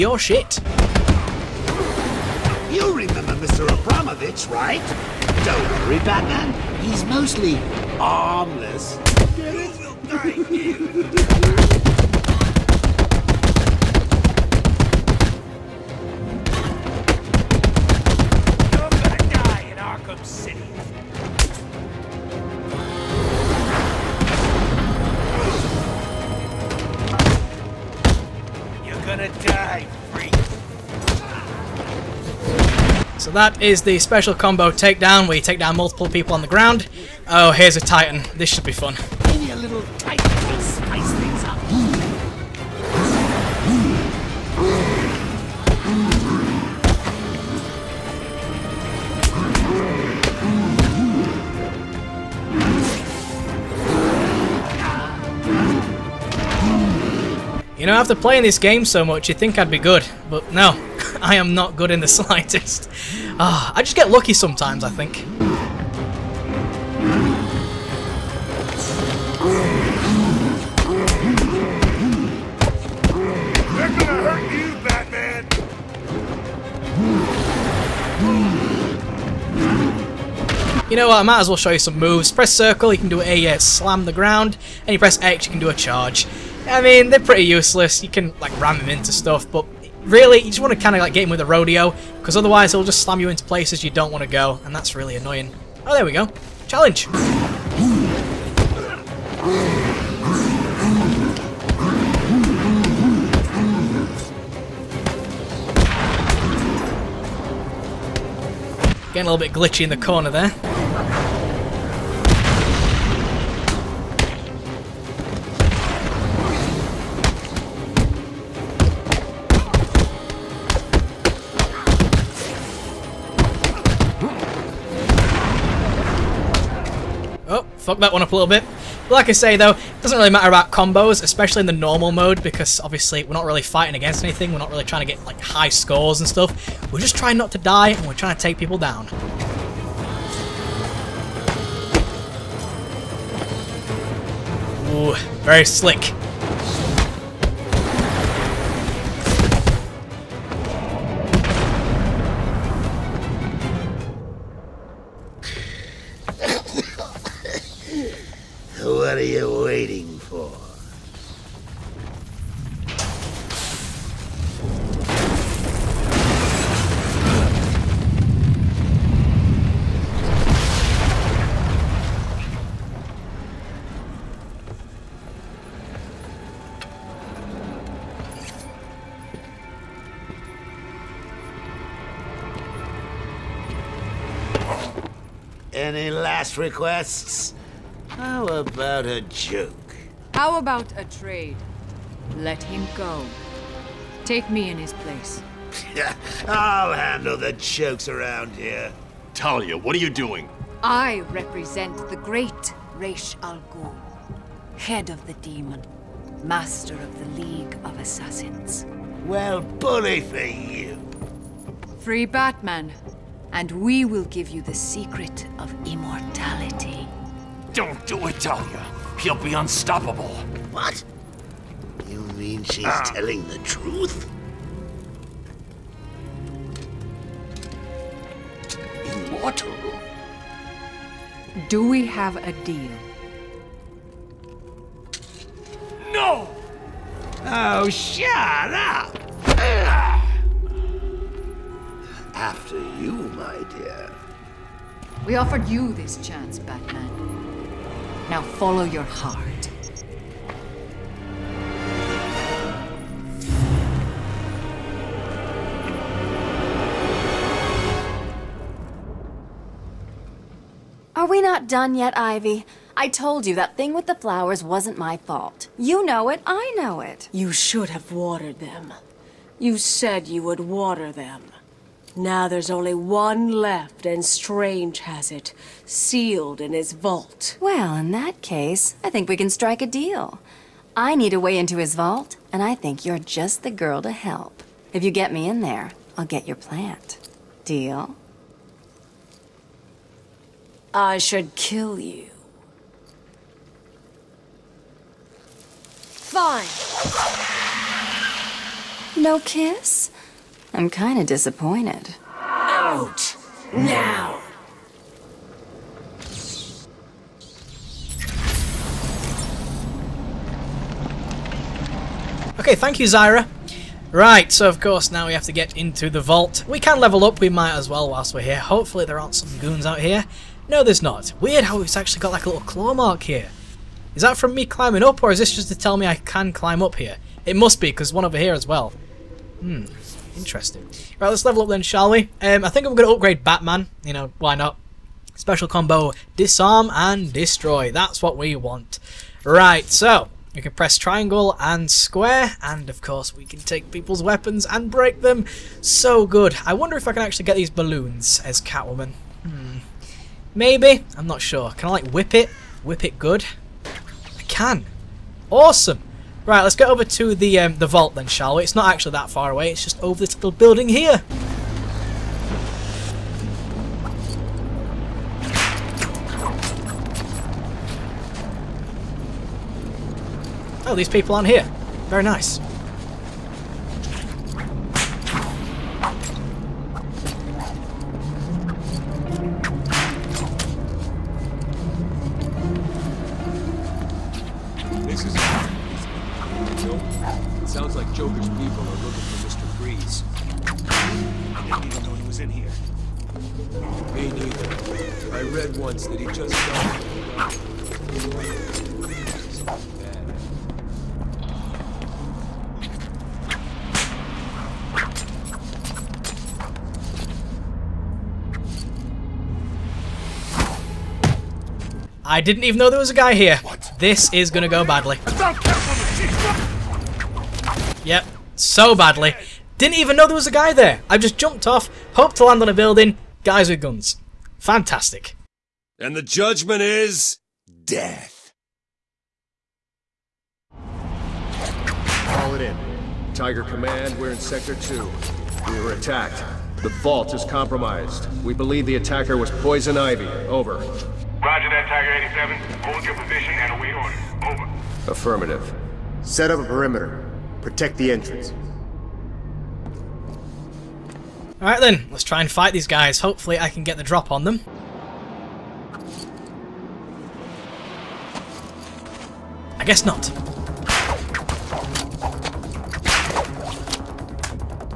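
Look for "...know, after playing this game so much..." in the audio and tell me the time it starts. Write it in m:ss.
0:57.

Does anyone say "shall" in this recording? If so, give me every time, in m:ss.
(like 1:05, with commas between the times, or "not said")
5:31, 5:58.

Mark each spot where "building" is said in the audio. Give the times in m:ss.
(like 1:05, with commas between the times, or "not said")
6:00, 7:02.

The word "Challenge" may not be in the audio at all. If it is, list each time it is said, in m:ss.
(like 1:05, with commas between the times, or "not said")
1:36.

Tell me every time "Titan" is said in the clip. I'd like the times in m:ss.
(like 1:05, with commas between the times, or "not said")
0:37.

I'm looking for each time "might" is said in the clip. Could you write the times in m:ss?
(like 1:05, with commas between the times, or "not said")
1:21, 5:17.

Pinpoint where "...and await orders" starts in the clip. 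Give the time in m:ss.
7:23.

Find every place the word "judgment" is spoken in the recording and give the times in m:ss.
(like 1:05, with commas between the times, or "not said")
7:06.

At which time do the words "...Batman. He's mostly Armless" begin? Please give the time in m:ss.
0:06.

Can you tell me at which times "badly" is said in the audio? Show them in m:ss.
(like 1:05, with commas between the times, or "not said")
6:54, 6:58.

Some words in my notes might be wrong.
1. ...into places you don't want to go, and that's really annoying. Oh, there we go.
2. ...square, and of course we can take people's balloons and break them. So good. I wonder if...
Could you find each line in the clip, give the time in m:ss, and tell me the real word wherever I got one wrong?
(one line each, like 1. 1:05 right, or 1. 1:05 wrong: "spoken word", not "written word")
1. 1:33 right
2. 5:41 wrong: "weapons", not "balloons".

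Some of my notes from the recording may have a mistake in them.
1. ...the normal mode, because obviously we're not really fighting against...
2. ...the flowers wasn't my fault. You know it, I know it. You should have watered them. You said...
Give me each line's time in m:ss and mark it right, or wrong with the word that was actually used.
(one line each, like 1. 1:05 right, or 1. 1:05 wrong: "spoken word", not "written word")
1. 2:11 right
2. 4:24 right.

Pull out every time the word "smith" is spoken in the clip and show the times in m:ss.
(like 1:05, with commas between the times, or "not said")
not said.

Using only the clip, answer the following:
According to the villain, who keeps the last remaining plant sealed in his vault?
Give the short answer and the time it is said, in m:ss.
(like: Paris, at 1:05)
Strange, at 4:34.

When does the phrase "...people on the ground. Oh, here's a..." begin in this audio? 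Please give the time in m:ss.
0:36.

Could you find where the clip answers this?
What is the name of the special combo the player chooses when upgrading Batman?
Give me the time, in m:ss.
5:36.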